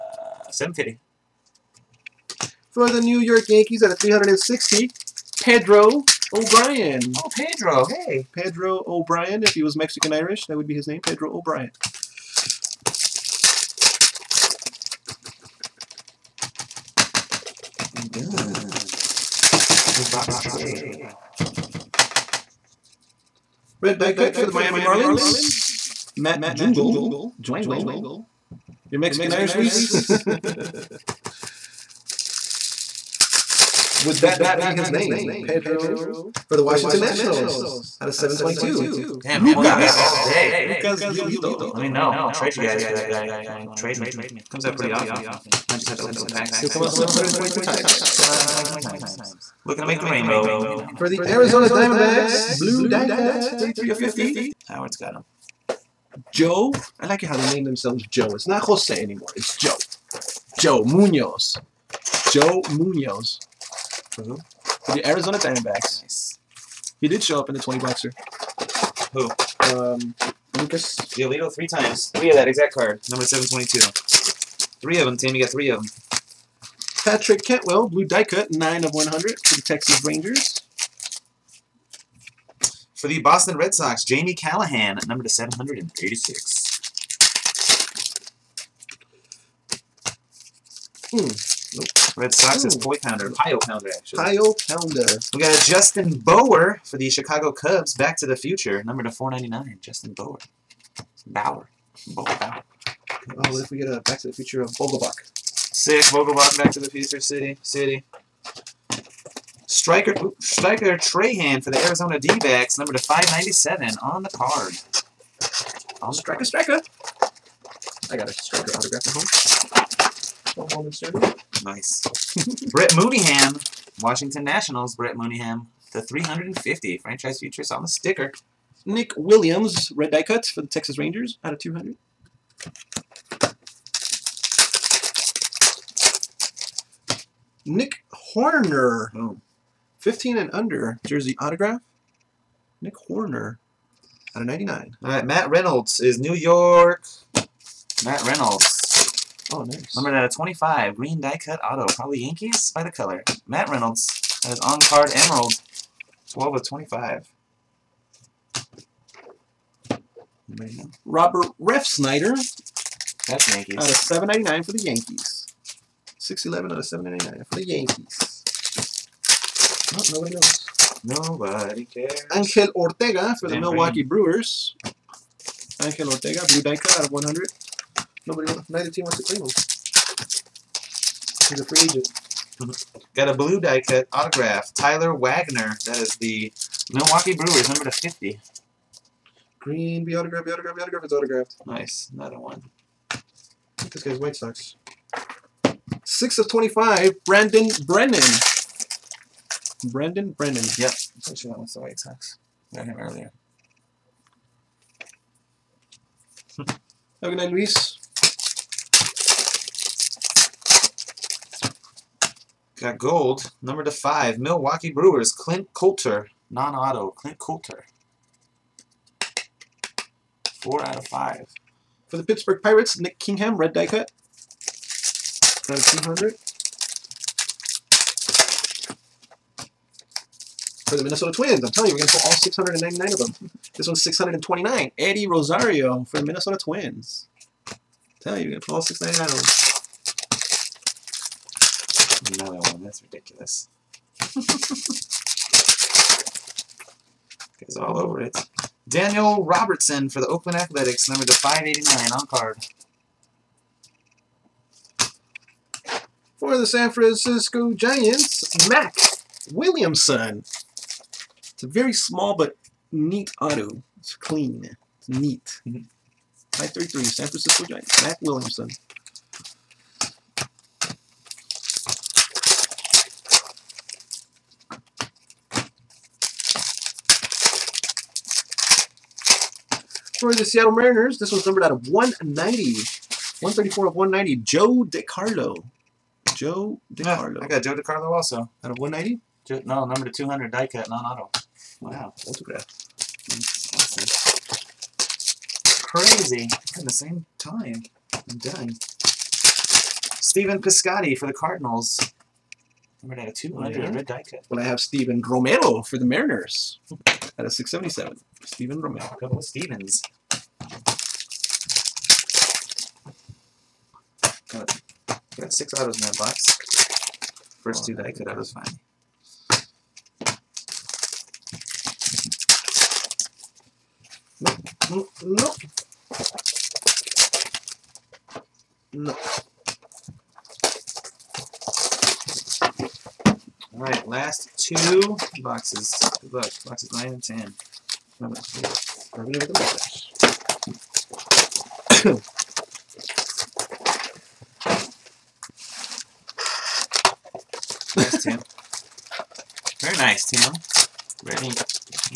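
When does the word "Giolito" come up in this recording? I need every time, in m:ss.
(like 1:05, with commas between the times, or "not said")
0:41, 1:11.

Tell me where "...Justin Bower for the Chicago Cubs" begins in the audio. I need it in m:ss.
1:35.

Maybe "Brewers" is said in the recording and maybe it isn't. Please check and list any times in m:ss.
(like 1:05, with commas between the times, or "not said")
2:54, 3:07, 3:34.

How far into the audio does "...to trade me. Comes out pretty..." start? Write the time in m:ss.
0:43.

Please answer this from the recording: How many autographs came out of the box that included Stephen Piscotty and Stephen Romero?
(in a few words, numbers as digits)
6.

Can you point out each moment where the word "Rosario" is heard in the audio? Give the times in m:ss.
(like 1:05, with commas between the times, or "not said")
3:55.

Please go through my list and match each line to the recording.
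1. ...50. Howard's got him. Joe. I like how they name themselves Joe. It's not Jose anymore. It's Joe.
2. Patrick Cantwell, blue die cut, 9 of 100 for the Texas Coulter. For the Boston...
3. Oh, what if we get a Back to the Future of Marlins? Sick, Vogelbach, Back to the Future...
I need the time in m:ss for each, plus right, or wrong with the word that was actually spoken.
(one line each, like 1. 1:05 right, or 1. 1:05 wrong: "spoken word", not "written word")
1. 0:53 right
2. 1:17 wrong: "Rangers", not "Coulter"
3. 1:43 wrong: "Vogelbach", not "Marlins".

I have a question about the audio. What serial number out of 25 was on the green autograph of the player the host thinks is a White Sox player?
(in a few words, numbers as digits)
6.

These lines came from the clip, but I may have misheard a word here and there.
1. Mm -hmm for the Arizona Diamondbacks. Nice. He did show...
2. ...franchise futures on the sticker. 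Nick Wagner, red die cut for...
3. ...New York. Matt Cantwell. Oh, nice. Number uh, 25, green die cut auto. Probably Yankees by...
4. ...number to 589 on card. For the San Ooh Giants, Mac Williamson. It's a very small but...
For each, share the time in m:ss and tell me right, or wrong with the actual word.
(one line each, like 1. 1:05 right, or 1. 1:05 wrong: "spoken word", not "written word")
1. 1:04 right
2. 2:06 wrong: "Williams", not "Wagner"
3. 2:26 wrong: "Reynolds", not "Cantwell"
4. 4:11 wrong: "Francisco", not "Ooh".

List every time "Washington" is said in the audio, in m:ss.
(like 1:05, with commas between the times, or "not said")
0:36, 2:04.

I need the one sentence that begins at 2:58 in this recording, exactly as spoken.
Nobody, wants, neither team wants to claim him.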